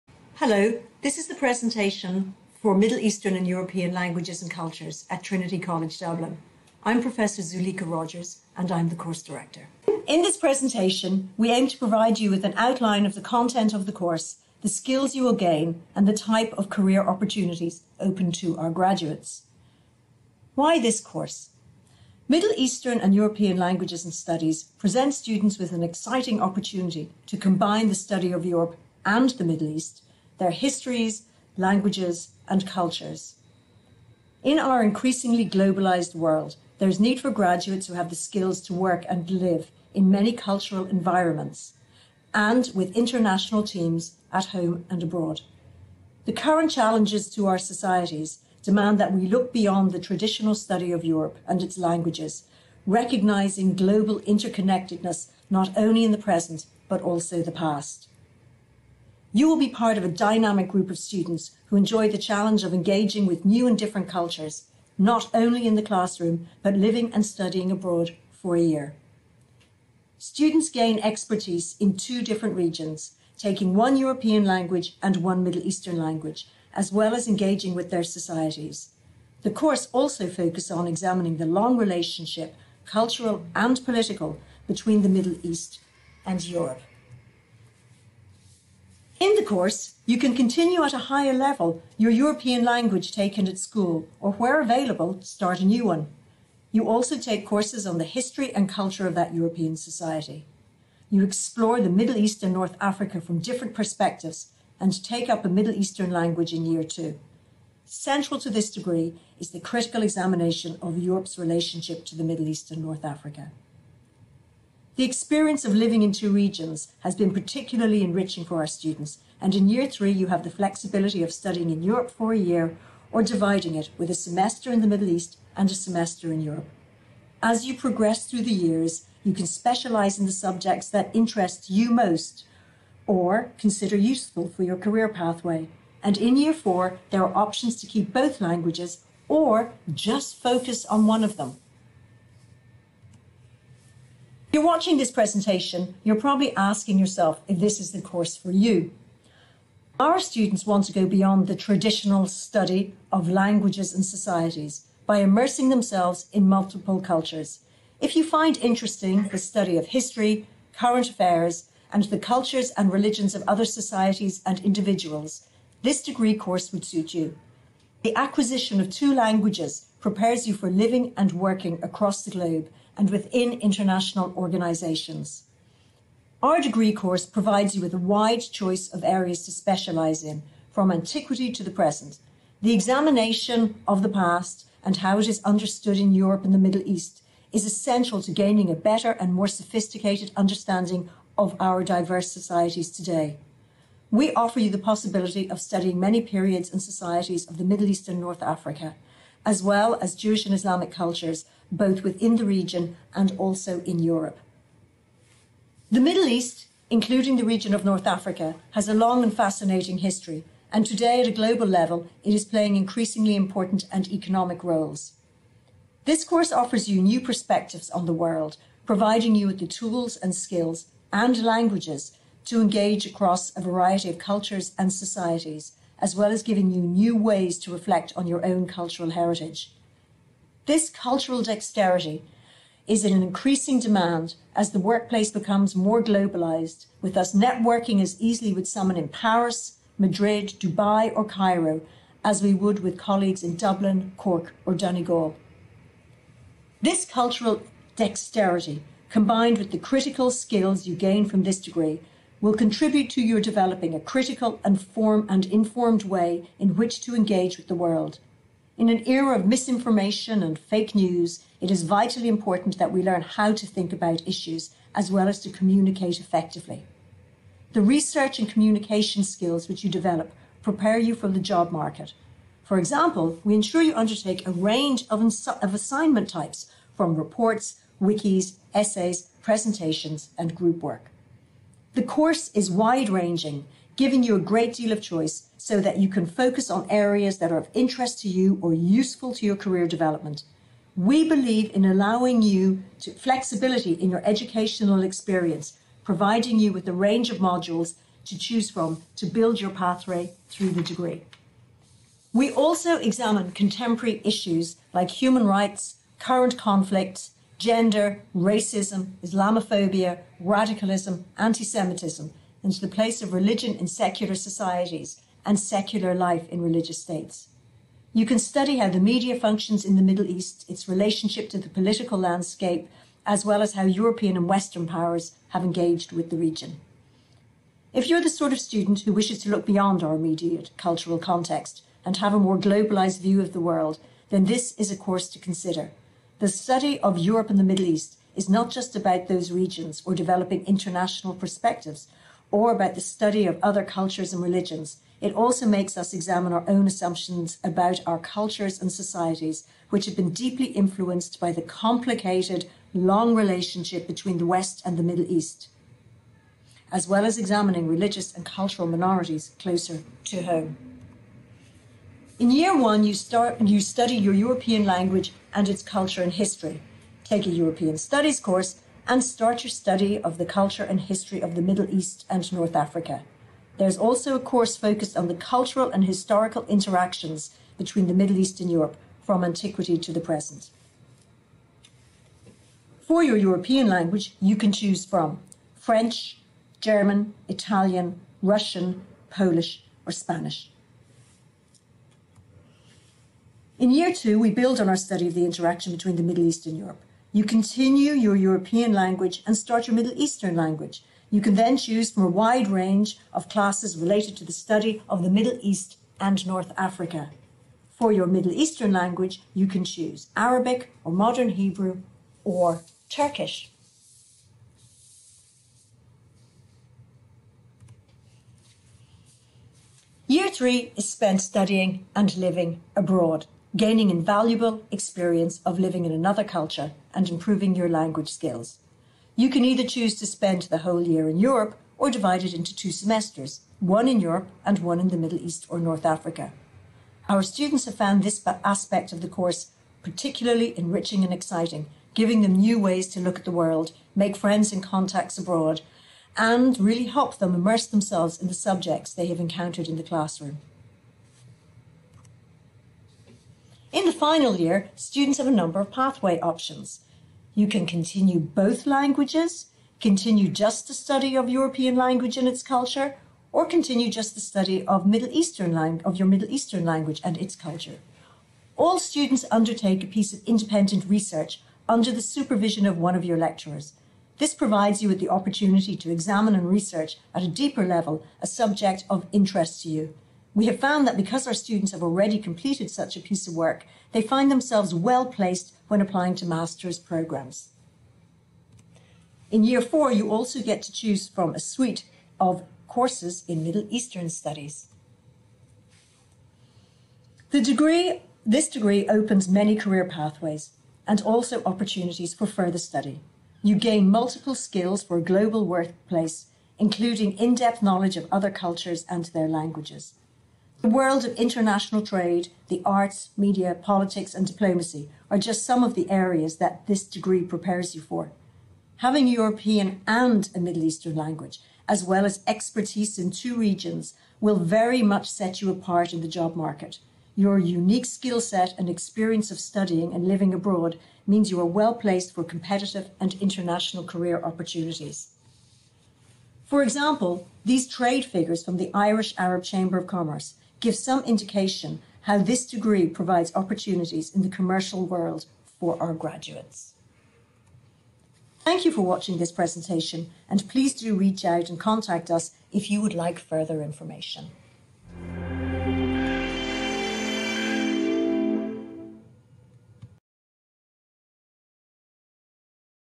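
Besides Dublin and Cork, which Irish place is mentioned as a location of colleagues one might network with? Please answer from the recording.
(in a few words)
Donegal.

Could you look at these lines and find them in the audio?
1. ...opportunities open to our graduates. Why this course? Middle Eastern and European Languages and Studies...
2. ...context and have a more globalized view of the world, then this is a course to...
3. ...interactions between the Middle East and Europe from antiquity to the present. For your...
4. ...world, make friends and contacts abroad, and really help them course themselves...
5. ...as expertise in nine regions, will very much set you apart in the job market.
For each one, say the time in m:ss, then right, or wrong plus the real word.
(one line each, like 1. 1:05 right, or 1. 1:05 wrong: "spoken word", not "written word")
1. 0:17 right
2. 5:31 right
3. 6:16 right
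4. 7:23 wrong: "immerse", not "course"
5. 8:42 wrong: "two", not "nine".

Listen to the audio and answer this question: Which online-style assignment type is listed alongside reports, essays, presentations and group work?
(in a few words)
Wikis.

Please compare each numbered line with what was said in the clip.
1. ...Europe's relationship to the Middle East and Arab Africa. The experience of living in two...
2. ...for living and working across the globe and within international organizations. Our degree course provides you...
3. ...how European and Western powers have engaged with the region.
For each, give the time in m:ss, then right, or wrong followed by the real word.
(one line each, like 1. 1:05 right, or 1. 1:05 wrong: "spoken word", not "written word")
1. 1:50 wrong: "North", not "Arab"
2. 2:50 right
3. 5:23 right.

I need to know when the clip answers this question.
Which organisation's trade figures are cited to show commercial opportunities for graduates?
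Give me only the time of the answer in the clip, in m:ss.
8:58.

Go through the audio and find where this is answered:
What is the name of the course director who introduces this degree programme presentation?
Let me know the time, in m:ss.
0:07.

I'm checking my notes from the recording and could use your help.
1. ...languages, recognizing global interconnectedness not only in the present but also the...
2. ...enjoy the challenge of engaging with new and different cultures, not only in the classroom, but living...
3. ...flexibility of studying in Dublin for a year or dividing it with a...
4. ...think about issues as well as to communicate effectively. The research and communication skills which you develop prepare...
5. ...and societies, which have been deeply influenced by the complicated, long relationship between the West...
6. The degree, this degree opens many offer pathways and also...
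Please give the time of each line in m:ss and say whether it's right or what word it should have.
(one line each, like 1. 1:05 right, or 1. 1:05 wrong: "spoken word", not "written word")
1. 0:51 right
2. 1:01 right
3. 2:00 wrong: "Europe", not "Dublin"
4. 4:23 right
5. 5:48 right
6. 8:17 wrong: "career", not "offer".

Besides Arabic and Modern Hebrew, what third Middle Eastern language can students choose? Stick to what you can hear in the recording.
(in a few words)
Turkish.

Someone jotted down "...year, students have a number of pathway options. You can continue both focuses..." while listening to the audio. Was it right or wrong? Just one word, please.
wrong.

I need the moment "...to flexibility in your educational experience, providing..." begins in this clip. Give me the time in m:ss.
4:53.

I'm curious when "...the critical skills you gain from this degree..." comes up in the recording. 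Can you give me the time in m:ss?
4:09.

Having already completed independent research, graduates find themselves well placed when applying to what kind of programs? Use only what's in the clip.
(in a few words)
Master's programs.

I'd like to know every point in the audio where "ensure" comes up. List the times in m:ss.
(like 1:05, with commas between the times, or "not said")
4:33.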